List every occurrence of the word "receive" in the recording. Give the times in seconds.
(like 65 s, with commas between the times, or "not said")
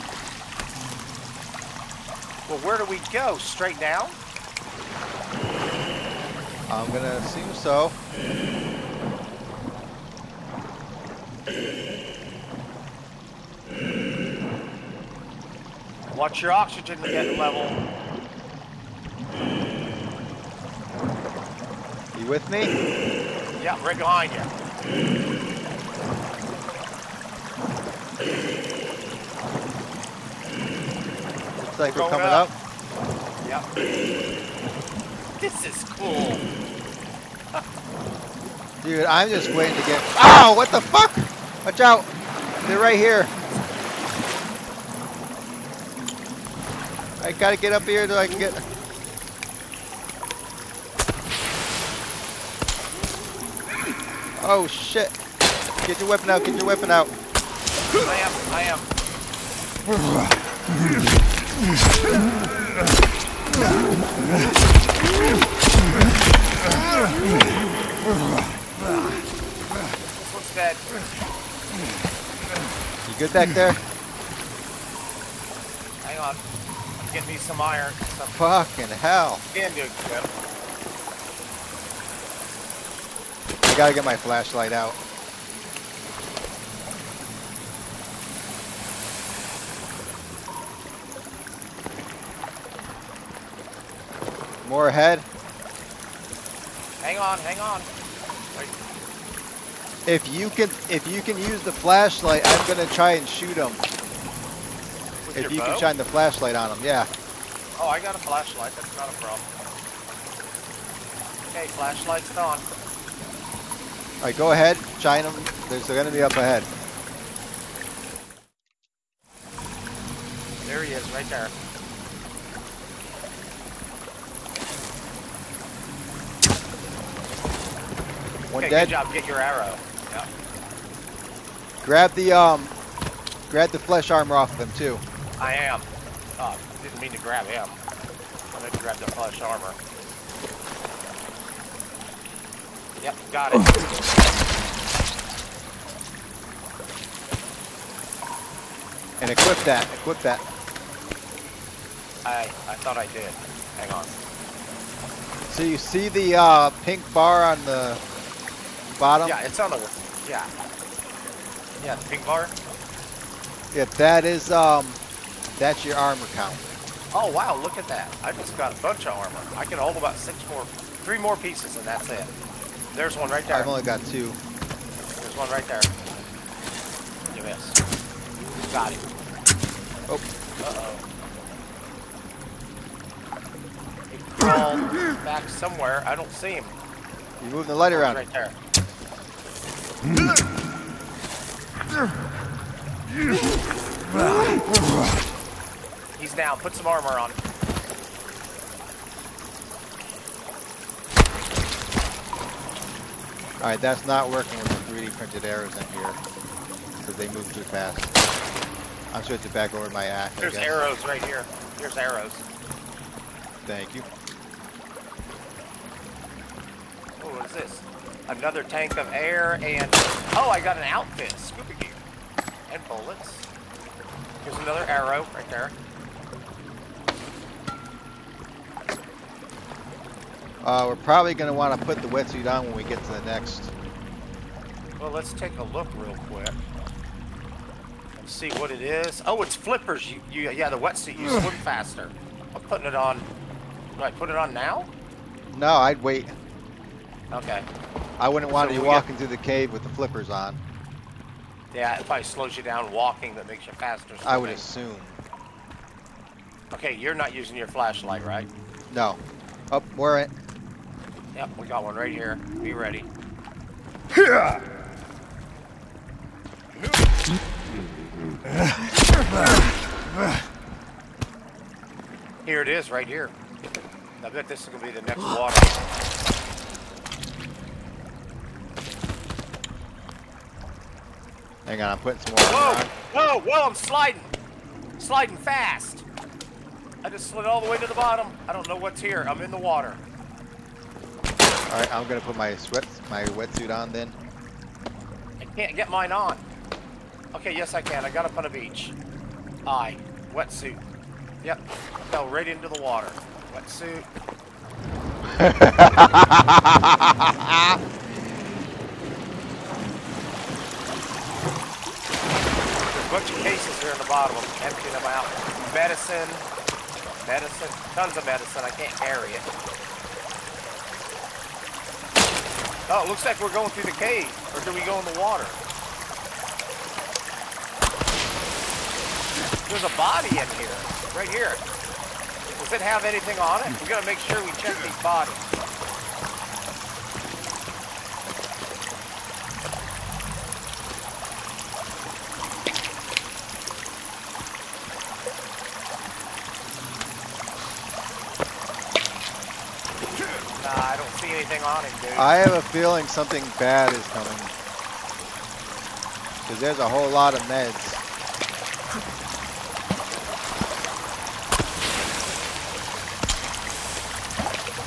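not said.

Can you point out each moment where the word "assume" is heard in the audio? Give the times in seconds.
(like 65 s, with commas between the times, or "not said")
7 s, 254 s.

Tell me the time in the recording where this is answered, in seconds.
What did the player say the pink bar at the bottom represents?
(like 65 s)
165 s.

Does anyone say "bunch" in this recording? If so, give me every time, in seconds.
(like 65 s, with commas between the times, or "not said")
168 s, 313 s.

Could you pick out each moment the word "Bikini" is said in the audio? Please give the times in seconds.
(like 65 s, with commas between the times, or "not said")
not said.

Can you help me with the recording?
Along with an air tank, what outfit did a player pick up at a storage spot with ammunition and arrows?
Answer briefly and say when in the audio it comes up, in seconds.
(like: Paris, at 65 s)
scuba gear, at 221 s.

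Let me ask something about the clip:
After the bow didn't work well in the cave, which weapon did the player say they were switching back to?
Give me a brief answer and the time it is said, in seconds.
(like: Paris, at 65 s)
axe, at 210 s.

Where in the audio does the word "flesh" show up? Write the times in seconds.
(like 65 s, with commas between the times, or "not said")
133 s, 139 s.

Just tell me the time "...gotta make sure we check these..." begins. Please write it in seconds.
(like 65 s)
333 s.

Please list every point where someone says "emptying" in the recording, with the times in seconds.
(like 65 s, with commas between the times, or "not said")
314 s.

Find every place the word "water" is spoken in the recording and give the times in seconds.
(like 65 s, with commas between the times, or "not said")
275 s, 289 s, 302 s, 325 s.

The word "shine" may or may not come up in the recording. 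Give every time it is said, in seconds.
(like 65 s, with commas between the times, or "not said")
105 s, 114 s.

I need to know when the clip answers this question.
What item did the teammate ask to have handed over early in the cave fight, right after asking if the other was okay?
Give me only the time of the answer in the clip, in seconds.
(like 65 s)
77 s.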